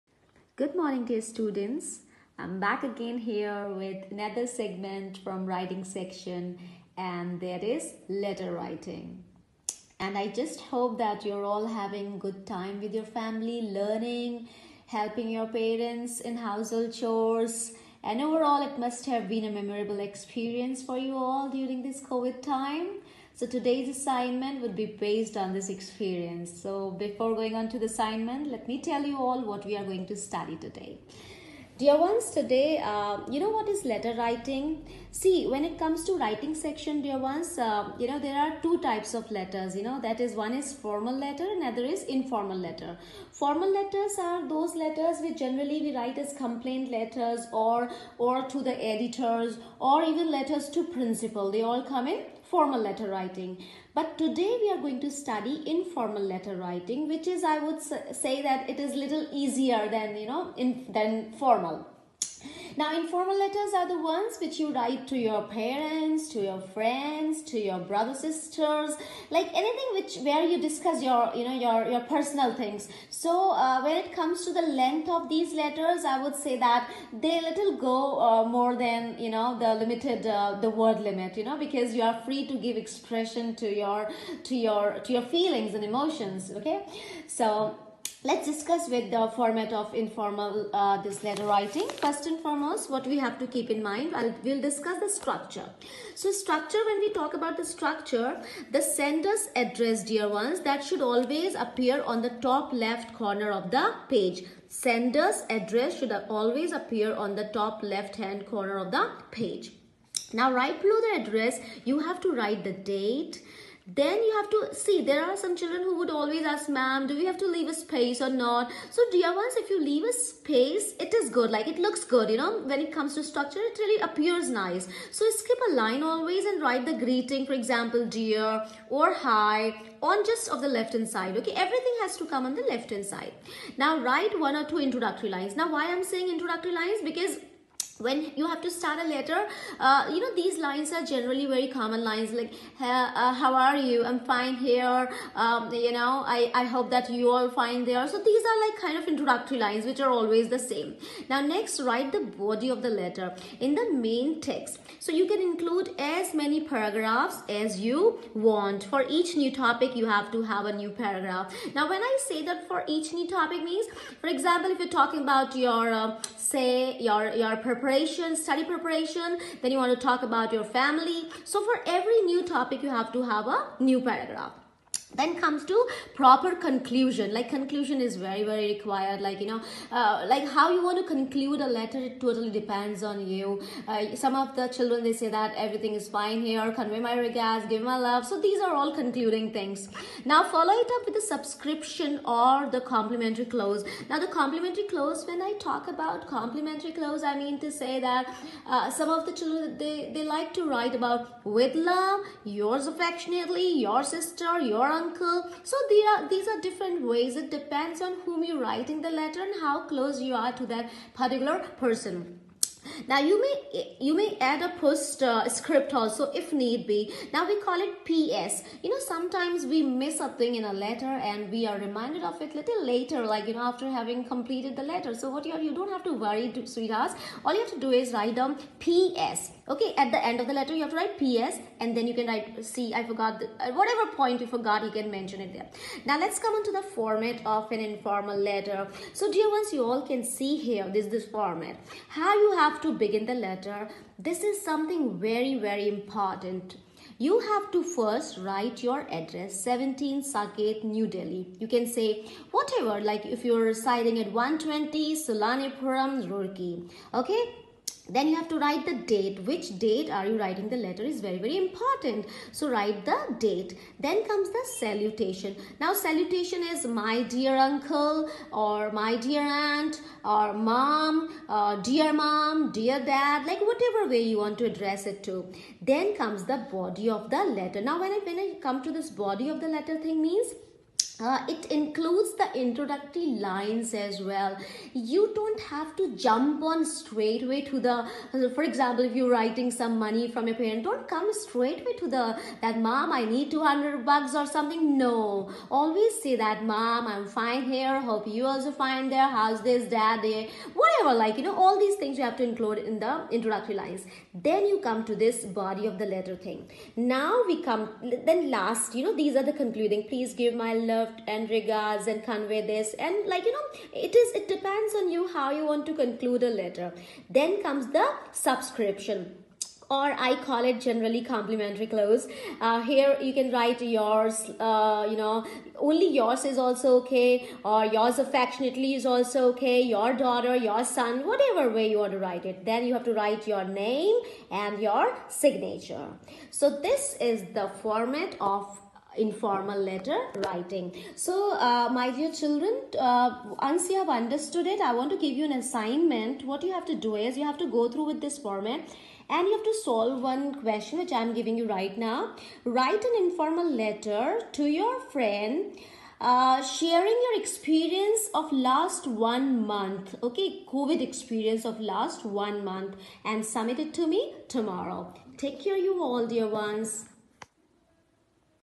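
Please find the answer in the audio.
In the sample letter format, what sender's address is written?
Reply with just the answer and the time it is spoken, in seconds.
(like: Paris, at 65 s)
17 Saket New Delhi, at 249 s.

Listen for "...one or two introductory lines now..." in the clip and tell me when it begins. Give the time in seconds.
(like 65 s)
134 s.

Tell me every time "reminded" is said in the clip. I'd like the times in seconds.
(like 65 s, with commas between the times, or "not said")
221 s.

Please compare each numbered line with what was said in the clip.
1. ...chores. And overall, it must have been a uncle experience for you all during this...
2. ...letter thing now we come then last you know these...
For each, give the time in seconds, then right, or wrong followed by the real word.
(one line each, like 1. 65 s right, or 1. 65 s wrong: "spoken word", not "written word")
1. 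16 s wrong: "memorable", not "uncle"
2. 306 s right.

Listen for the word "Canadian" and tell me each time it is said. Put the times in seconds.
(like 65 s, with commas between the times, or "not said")
not said.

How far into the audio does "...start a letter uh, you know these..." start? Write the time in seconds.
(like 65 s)
138 s.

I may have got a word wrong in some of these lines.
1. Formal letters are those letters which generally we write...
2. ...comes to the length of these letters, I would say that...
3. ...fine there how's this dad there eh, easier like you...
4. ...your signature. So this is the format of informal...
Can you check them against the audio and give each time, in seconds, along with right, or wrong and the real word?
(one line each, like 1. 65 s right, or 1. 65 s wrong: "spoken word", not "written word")
1. 43 s right
2. 74 s right
3. 298 s wrong: "whatever", not "easier"
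4. 334 s right.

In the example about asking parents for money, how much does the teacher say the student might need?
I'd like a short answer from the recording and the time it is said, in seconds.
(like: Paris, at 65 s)
200 bucks, at 293 s.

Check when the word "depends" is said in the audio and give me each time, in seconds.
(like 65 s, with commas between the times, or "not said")
182 s, 207 s, 314 s.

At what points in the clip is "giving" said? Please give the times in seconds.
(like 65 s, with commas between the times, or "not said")
351 s.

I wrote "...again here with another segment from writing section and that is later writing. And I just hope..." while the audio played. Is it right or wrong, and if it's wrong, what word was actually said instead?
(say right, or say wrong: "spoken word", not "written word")
wrong: "letter", not "later".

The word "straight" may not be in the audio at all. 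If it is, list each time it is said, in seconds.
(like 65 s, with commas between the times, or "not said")
286 s, 291 s.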